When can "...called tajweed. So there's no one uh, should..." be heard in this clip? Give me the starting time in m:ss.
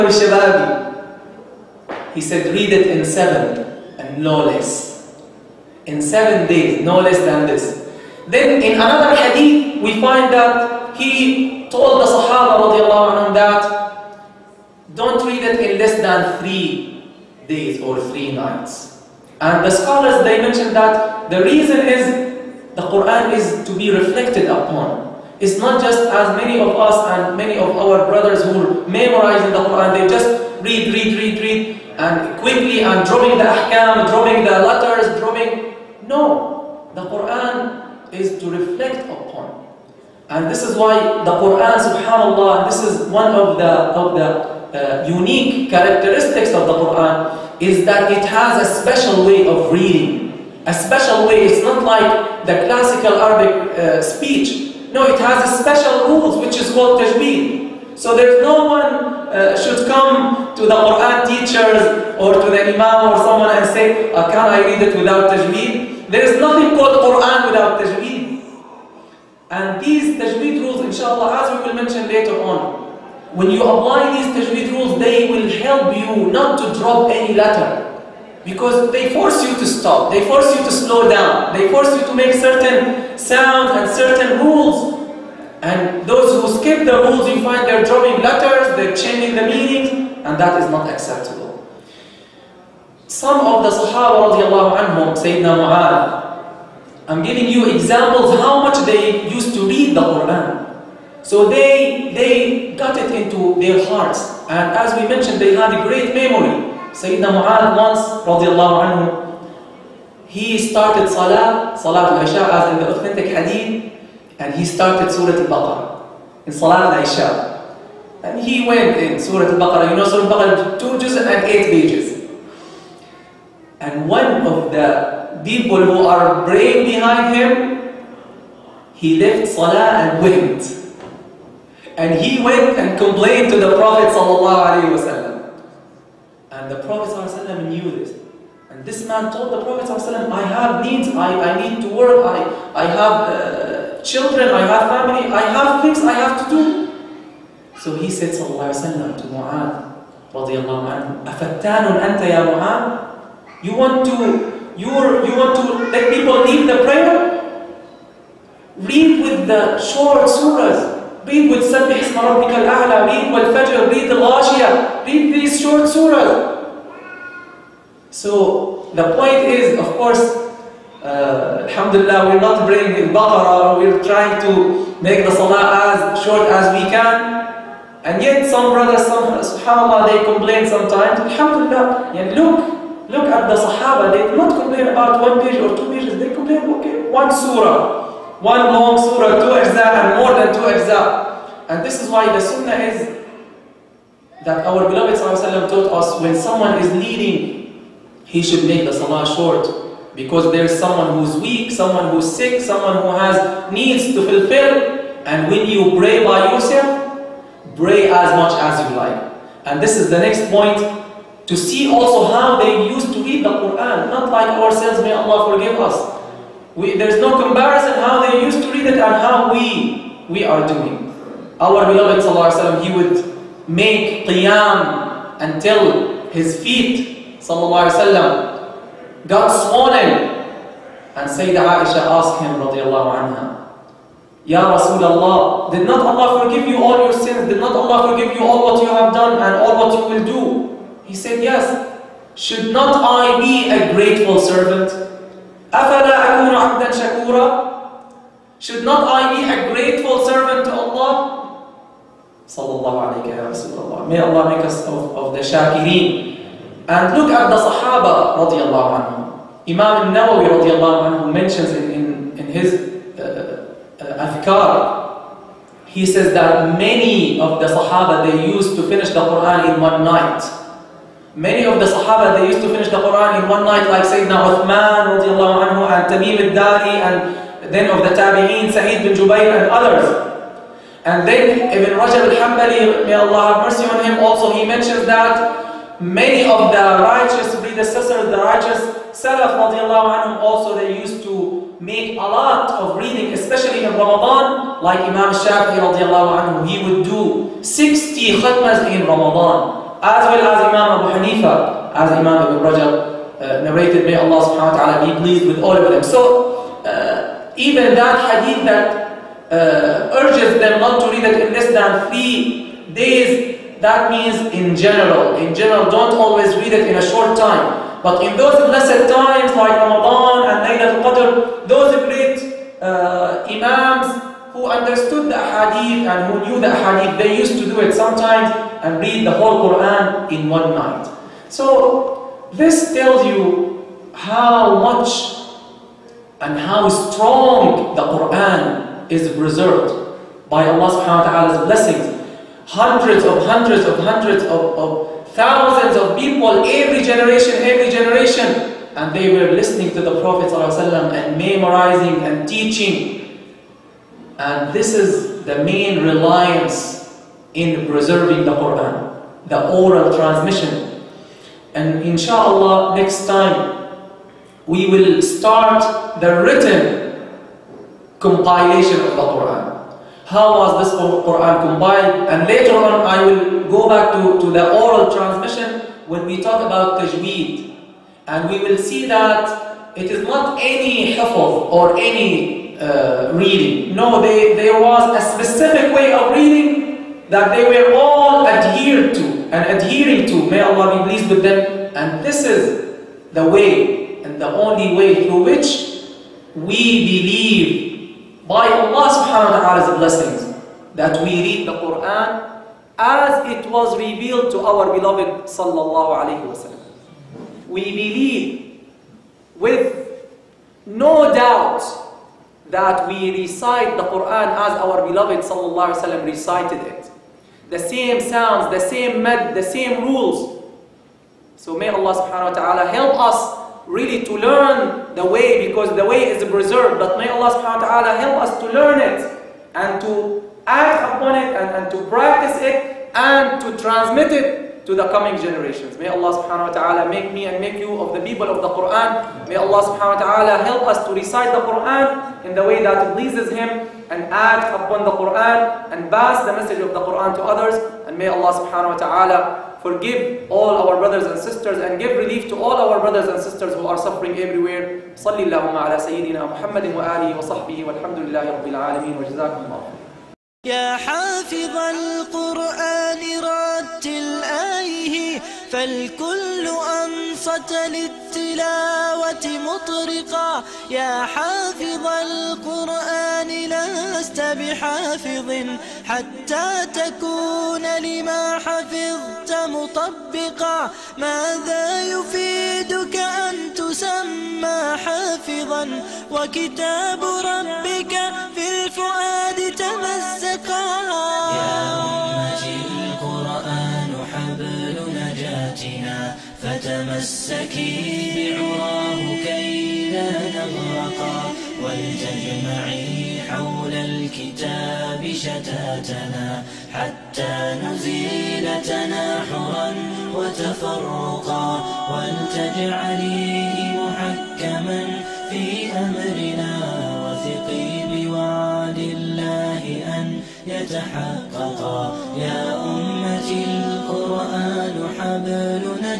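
0:56.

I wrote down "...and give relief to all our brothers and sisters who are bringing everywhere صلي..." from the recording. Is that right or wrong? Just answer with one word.
wrong.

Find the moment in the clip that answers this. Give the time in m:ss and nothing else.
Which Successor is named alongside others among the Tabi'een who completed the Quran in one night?
4:38.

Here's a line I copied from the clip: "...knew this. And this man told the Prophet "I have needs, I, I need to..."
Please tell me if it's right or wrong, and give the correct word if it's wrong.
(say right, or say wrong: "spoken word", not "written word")
right.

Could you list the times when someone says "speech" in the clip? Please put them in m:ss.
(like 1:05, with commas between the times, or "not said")
0:54.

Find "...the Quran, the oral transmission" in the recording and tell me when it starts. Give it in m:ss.
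5:58.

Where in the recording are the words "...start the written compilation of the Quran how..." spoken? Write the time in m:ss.
6:05.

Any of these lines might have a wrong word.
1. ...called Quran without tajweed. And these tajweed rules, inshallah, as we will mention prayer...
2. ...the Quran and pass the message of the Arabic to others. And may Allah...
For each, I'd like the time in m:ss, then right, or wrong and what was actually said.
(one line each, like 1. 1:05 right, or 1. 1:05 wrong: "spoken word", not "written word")
1. 1:06 wrong: "later", not "prayer"
2. 7:25 wrong: "Quran", not "Arabic".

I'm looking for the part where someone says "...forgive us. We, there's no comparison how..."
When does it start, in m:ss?
3:35.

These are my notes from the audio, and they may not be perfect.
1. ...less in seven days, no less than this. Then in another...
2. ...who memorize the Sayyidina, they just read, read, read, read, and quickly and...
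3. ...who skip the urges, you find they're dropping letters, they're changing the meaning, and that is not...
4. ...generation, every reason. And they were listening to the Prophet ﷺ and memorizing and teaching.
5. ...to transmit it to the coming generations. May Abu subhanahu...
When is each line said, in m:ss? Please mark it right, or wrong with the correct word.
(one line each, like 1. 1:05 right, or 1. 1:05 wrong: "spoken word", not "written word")
1. 0:04 right
2. 0:28 wrong: "Quran", not "Sayyidina"
3. 1:26 wrong: "rules", not "urges"
4. 5:47 wrong: "generation", not "reason"
5. 7:13 wrong: "Allah", not "Abu".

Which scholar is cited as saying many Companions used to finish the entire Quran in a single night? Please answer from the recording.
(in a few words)
Imam al-Nawawi.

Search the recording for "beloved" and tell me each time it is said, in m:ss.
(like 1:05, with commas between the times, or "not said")
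3:14, 3:41, 6:44, 6:55.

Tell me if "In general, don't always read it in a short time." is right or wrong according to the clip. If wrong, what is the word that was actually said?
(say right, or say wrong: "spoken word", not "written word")
right.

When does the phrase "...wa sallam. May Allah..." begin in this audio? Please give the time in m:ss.
4:13.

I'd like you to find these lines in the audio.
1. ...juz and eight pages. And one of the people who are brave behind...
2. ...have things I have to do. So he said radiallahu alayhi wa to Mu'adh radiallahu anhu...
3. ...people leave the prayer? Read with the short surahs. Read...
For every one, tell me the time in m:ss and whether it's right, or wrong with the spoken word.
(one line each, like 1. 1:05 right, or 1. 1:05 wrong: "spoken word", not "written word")
1. 2:00 right
2. 2:25 wrong: "sallallahu", not "radiallahu"
3. 2:36 right.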